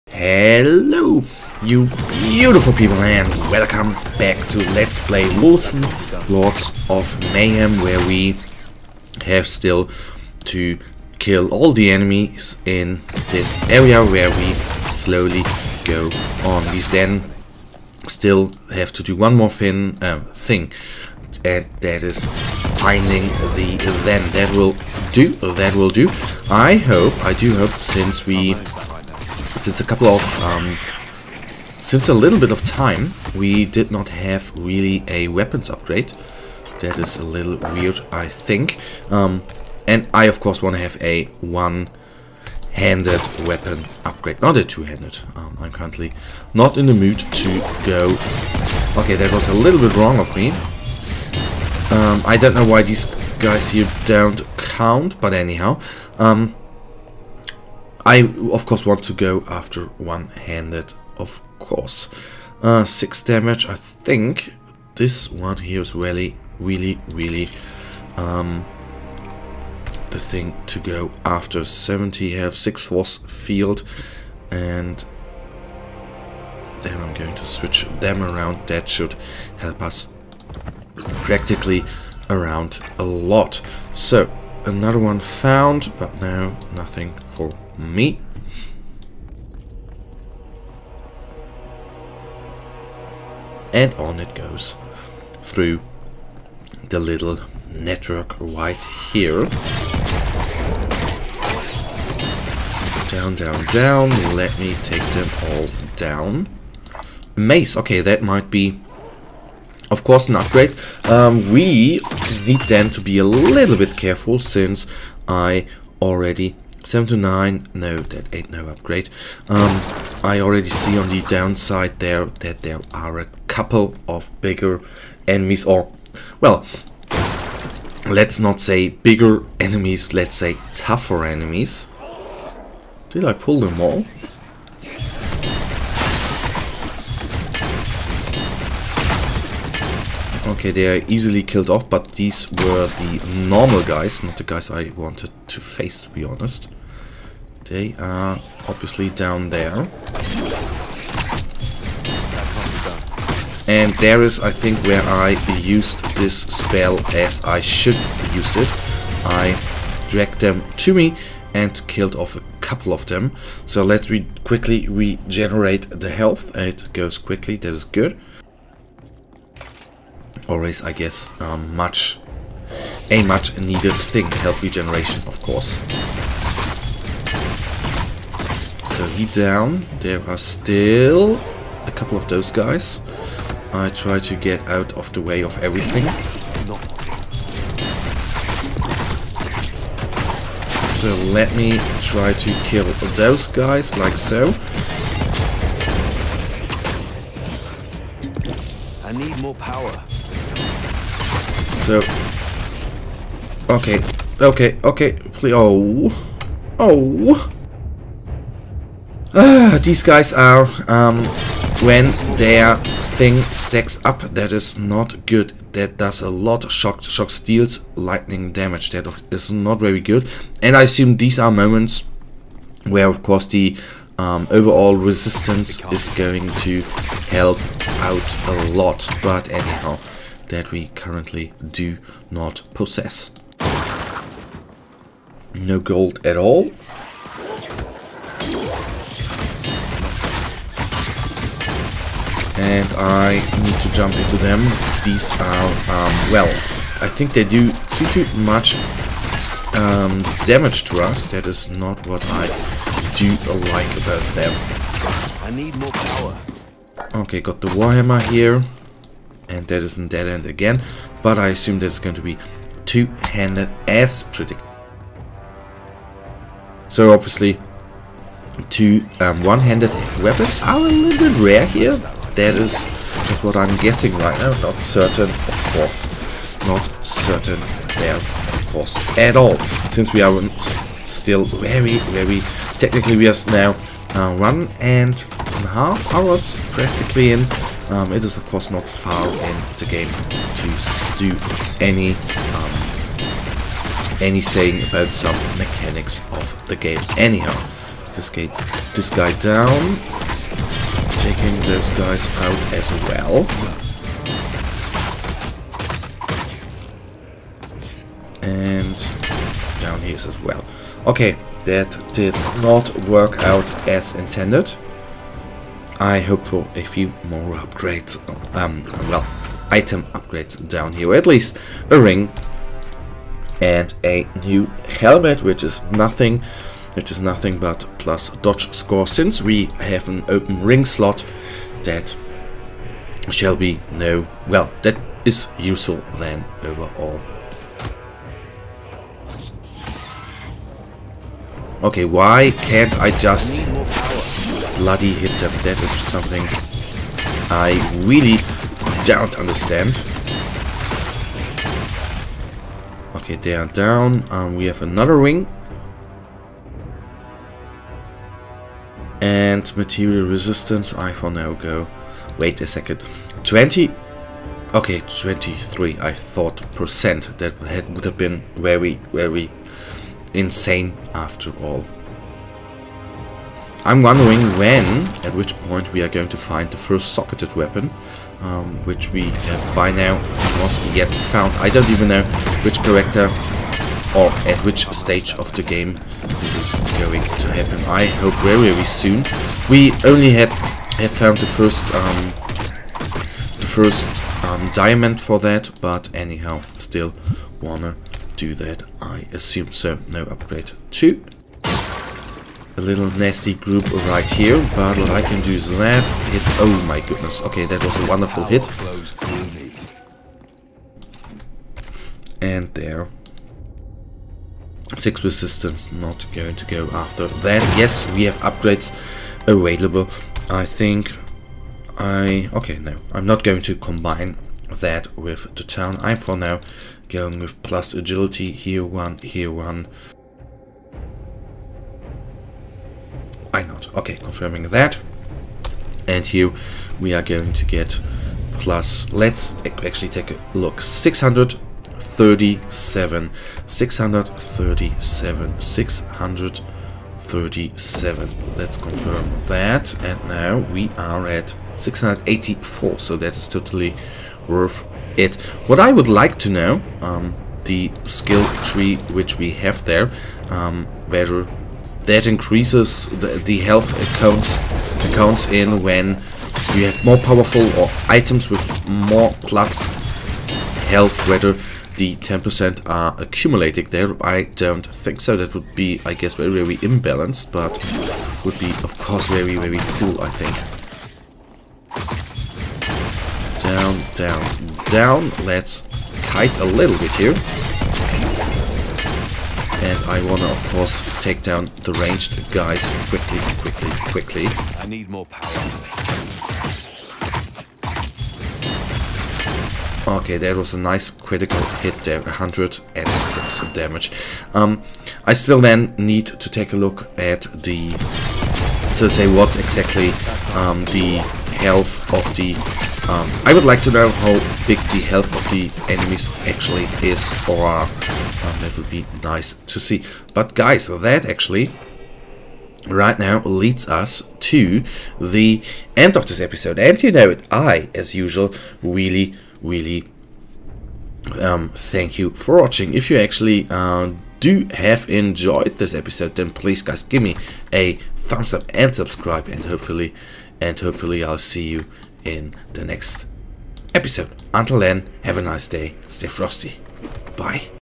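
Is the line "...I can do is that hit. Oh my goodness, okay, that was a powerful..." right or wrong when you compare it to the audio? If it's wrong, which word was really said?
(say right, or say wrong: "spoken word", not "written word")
wrong: "wonderful", not "powerful".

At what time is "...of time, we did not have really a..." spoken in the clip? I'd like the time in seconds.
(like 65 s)
32 s.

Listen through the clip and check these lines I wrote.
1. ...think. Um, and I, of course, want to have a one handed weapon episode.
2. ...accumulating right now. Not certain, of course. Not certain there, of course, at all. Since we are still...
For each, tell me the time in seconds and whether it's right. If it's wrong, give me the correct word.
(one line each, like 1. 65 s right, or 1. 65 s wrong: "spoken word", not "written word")
1. 38 s wrong: "upgrade", not "episode"
2. 273 s wrong: "guessing", not "accumulating".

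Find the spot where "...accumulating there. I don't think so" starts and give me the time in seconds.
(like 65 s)
473 s.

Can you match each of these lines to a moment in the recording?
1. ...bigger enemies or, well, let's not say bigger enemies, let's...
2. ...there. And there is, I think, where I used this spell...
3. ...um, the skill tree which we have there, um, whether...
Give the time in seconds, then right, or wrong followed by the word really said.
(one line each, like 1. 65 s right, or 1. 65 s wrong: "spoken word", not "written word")
1. 124 s right
2. 149 s right
3. 457 s right.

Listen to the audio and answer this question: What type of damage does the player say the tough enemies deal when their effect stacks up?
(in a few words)
Lightning damage.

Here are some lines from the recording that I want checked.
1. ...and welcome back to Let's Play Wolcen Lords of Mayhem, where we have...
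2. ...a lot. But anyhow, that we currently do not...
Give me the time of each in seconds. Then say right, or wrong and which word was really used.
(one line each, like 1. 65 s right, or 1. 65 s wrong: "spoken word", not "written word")
1. 2 s right
2. 228 s right.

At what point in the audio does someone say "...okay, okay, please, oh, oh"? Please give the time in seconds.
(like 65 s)
204 s.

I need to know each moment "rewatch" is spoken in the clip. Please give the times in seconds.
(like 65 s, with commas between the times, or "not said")
not said.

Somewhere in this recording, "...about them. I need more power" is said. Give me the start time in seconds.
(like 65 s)
254 s.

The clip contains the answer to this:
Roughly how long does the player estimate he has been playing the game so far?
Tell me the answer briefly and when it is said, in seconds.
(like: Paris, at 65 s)
One and a half hours, at 284 s.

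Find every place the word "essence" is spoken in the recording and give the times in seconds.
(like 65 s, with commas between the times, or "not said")
not said.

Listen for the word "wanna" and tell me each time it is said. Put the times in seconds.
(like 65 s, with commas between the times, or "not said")
397 s, 490 s.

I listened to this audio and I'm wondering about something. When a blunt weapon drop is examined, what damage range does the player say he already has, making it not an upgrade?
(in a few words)
7 to 9.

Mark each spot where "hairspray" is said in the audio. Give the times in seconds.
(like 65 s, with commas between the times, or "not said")
not said.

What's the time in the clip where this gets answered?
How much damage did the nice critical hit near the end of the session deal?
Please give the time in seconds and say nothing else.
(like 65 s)
502 s.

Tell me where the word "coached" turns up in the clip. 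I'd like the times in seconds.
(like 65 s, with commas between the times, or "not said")
not said.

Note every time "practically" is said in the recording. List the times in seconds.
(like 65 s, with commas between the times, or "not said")
80 s, 286 s.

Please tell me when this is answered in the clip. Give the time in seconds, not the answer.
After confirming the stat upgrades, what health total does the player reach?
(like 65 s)
451 s.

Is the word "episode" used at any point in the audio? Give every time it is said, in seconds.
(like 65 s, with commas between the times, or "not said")
526 s, 535 s, 543 s.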